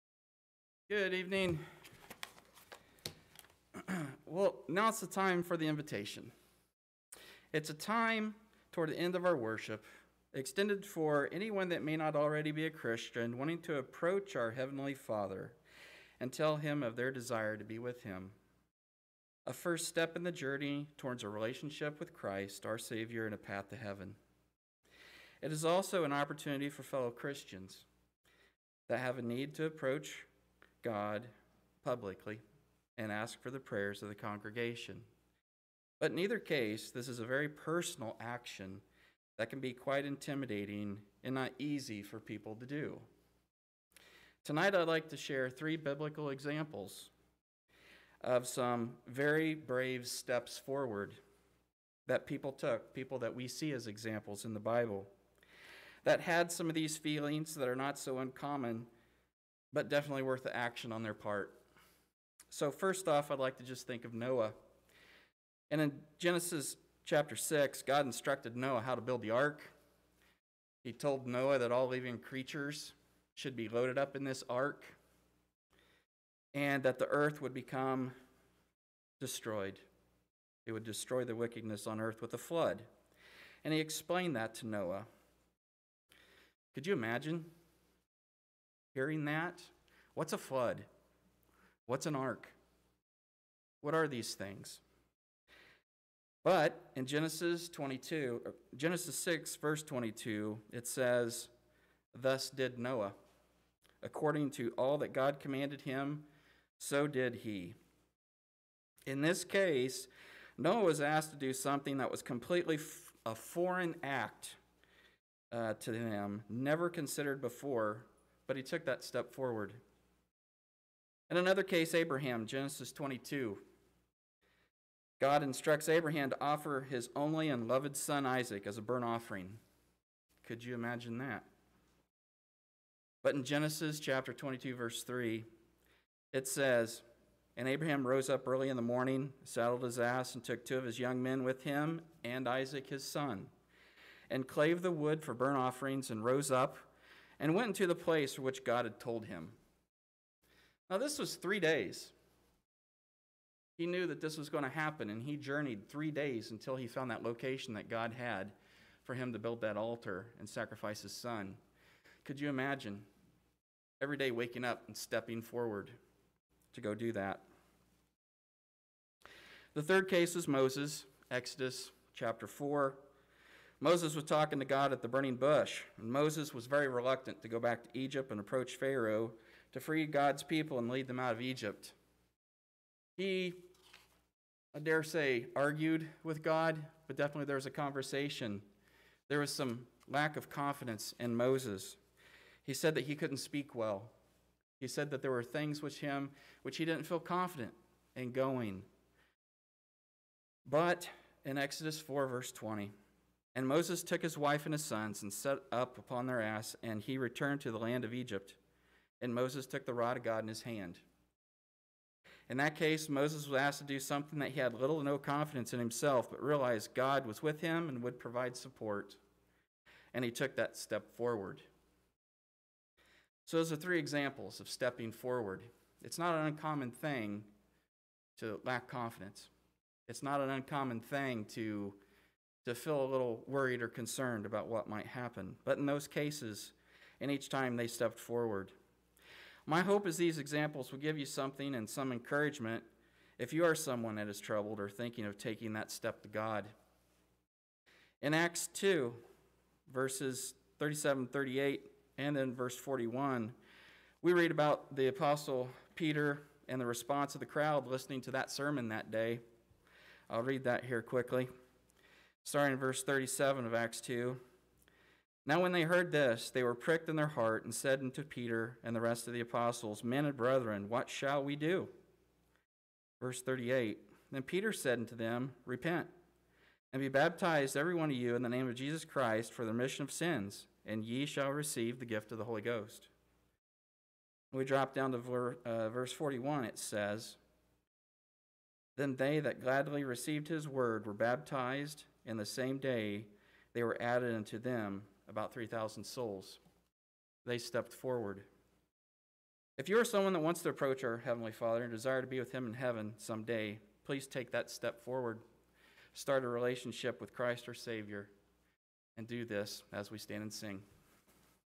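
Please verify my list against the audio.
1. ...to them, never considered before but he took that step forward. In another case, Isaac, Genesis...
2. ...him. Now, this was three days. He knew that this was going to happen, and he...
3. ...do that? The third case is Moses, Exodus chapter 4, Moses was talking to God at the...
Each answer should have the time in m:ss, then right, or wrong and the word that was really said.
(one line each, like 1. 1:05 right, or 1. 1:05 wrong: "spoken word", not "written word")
1. 1:55 wrong: "Abraham", not "Isaac"
2. 2:29 right
3. 2:46 right.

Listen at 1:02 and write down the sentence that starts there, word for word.
So, first off, I'd like to just think of Noah.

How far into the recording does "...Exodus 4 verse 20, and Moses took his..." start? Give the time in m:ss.
3:21.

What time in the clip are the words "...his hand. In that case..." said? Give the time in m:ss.
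3:30.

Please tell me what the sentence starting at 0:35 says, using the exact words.
But in either case, this is a very personal action that can be quite intimidating and not easy for people to do.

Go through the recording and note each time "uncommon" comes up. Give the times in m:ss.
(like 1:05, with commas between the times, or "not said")
0:58, 3:46, 3:50.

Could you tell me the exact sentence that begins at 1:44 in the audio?
According to all that God commanded him, so did he.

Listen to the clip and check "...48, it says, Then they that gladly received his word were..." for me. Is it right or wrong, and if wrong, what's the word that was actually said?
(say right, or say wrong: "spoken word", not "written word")
wrong: "41", not "48".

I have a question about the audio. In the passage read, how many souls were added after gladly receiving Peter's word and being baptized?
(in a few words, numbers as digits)
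3,000.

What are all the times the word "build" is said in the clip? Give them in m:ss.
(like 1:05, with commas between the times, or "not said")
1:09, 2:39.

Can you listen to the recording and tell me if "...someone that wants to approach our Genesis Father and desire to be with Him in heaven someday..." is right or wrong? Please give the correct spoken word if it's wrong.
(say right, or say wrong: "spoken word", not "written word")
wrong: "Heavenly", not "Genesis".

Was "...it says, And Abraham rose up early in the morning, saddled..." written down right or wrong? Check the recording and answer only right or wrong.
right.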